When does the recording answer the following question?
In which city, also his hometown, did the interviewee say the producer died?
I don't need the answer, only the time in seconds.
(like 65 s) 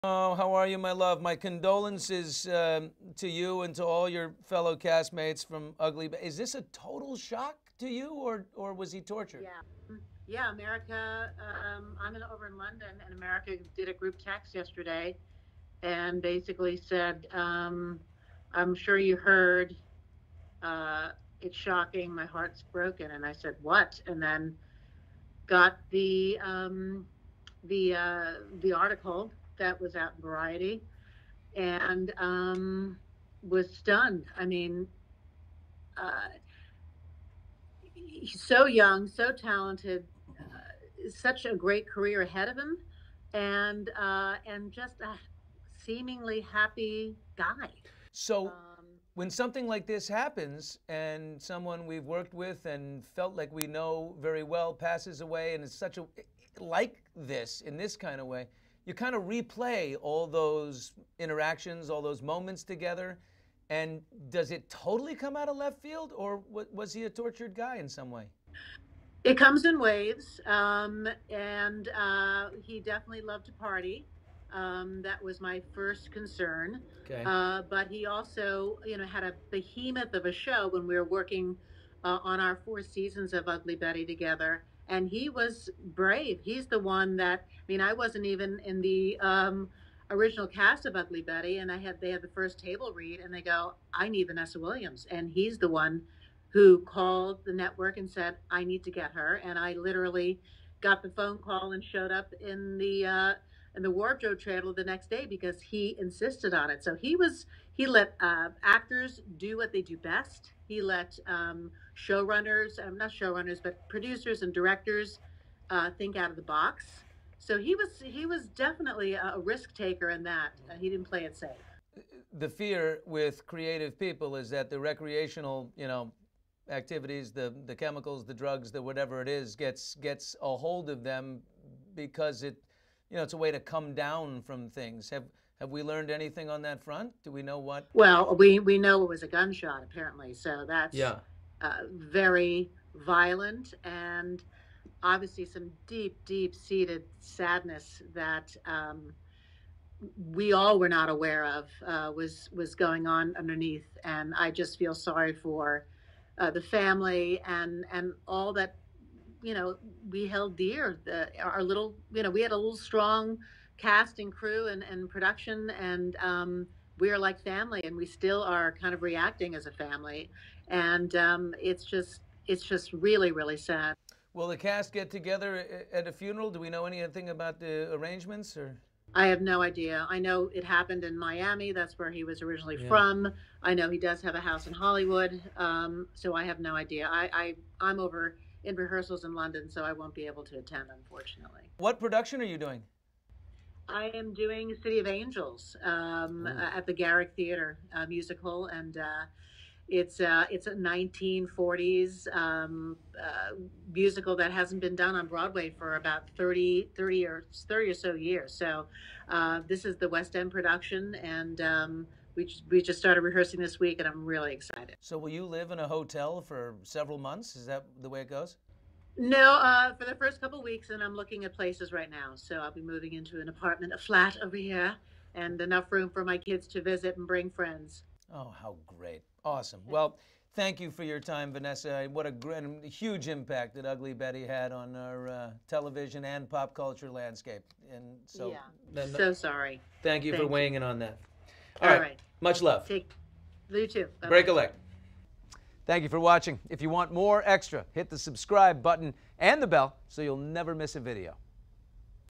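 181 s.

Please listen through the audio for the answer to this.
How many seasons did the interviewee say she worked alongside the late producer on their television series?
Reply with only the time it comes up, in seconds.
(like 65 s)
82 s.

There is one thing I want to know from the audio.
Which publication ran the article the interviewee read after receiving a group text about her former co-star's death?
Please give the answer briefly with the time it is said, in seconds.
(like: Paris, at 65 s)
Variety, at 30 s.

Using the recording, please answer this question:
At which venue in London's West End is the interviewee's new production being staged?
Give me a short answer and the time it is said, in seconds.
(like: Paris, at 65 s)
Garrick Theater, at 196 s.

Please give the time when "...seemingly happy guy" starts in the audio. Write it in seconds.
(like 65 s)
45 s.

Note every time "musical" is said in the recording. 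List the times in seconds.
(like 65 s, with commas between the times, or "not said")
198 s, 203 s.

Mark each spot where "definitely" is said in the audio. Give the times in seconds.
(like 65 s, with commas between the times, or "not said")
72 s, 118 s.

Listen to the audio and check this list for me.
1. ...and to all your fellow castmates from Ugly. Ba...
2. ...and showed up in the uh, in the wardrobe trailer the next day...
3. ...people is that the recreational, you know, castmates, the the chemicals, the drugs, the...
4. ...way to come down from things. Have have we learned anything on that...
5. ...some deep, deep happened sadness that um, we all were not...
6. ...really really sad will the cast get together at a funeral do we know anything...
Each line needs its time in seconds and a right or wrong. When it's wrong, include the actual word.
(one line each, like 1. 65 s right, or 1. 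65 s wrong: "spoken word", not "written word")
1. 3 s right
2. 101 s right
3. 123 s wrong: "activities", not "castmates"
4. 133 s right
5. 145 s wrong: "seated", not "happened"
6. 172 s right.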